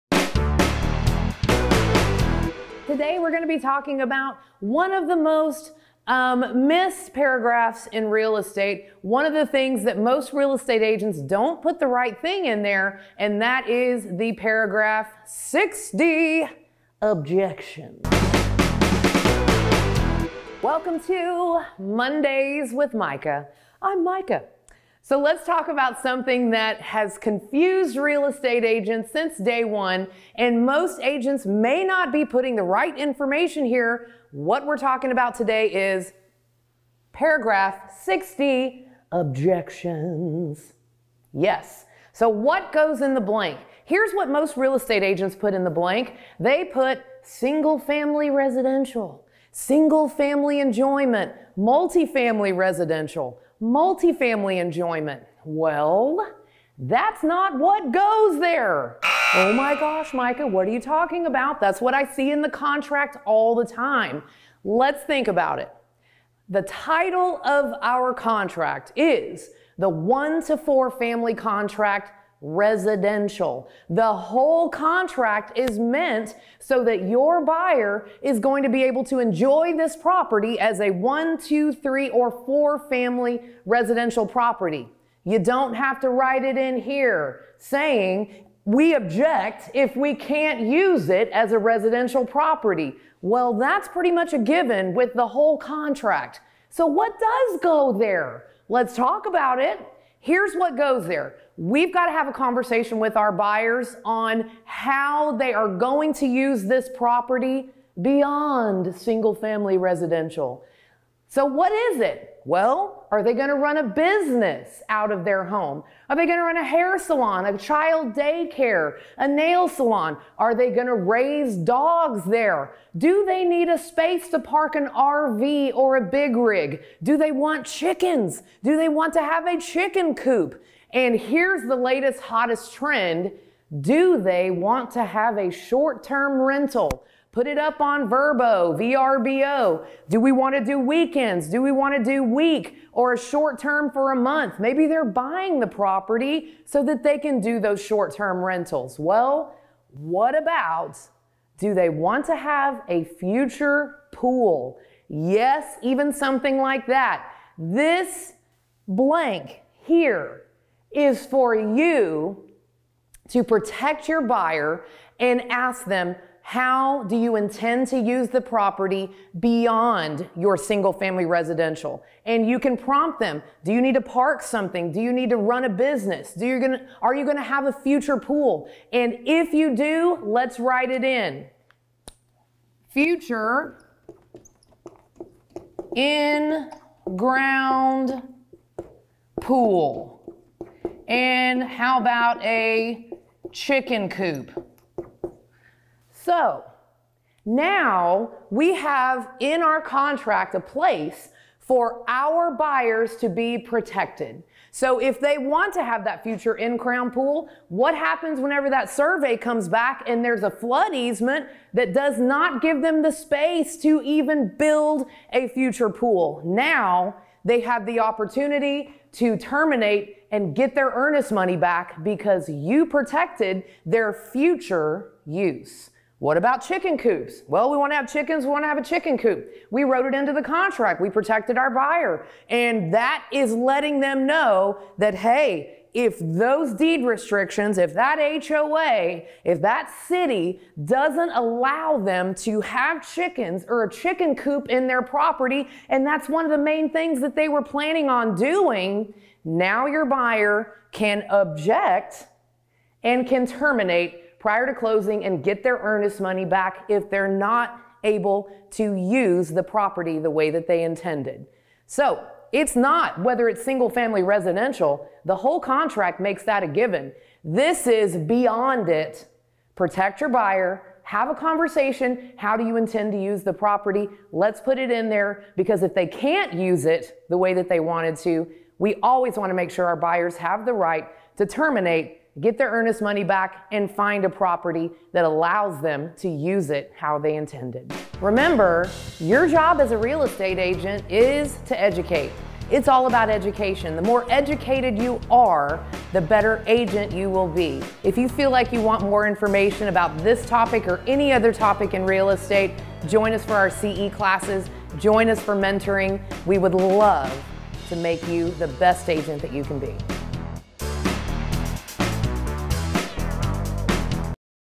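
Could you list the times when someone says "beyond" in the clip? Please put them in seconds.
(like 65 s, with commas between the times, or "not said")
108 s, 169 s, 268 s.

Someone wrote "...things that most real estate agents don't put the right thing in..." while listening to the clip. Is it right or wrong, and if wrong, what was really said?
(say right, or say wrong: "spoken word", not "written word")
right.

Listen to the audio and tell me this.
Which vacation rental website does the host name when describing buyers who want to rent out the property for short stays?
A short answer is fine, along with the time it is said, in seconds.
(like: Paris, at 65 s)
VRBO, at 138 s.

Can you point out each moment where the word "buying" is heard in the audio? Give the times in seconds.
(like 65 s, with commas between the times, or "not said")
145 s.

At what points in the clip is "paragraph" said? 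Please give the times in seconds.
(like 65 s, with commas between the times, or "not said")
7 s, 14 s, 37 s.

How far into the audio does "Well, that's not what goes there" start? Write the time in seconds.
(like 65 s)
55 s.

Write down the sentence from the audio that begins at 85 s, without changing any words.
You don't have to write it in here saying we object if we can't use it as a residential property.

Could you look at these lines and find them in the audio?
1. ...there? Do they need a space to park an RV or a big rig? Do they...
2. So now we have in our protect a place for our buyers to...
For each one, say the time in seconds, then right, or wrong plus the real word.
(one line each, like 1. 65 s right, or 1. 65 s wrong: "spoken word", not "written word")
1. 122 s right
2. 196 s wrong: "contract", not "protect".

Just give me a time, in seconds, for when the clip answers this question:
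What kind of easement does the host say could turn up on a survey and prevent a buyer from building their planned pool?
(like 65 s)
210 s.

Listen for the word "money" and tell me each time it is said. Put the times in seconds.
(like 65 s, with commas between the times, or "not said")
221 s, 256 s, 283 s.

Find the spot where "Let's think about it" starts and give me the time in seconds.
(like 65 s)
64 s.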